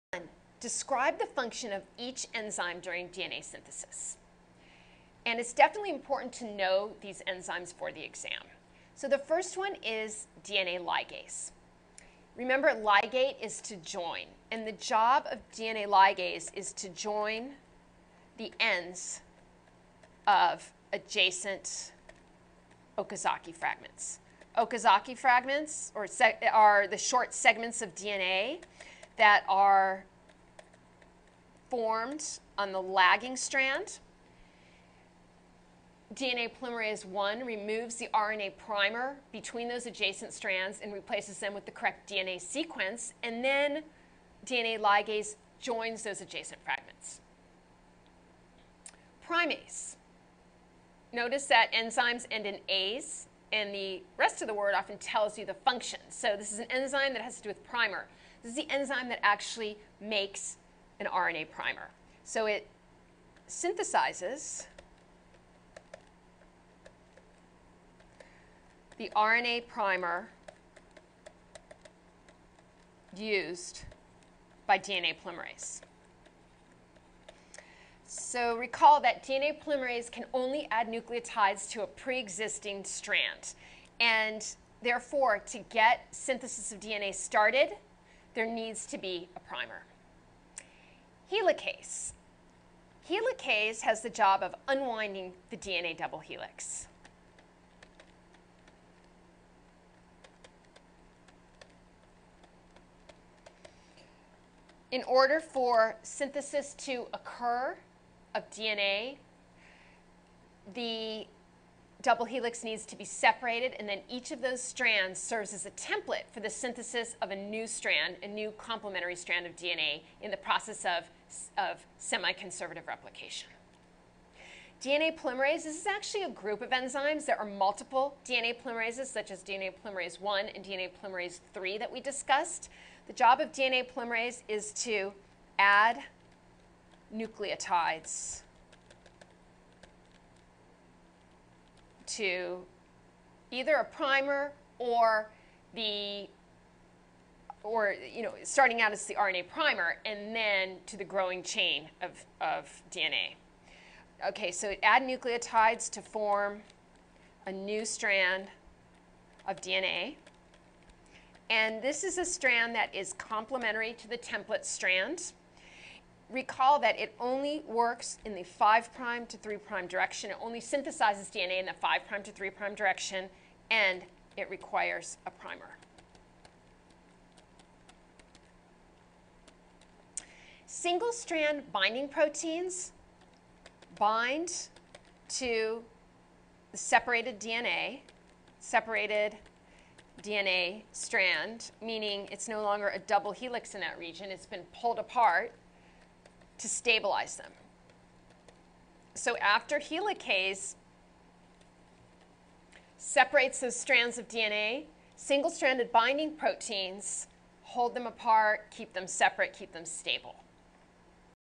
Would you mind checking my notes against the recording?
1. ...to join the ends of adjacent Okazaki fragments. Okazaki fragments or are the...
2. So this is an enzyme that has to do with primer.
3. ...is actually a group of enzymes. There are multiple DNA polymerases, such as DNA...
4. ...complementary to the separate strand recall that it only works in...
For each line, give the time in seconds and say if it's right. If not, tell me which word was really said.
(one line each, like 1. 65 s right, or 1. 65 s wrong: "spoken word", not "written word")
1. 16 s right
2. 56 s right
3. 125 s right
4. 163 s wrong: "template", not "separate".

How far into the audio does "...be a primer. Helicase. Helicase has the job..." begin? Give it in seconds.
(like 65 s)
88 s.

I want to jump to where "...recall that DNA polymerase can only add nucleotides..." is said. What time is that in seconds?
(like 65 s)
78 s.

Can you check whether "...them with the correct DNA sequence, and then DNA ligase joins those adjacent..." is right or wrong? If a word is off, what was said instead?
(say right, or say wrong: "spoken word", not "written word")
right.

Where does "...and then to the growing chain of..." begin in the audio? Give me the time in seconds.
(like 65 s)
150 s.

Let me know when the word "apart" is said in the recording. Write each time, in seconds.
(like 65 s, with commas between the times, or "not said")
194 s, 208 s.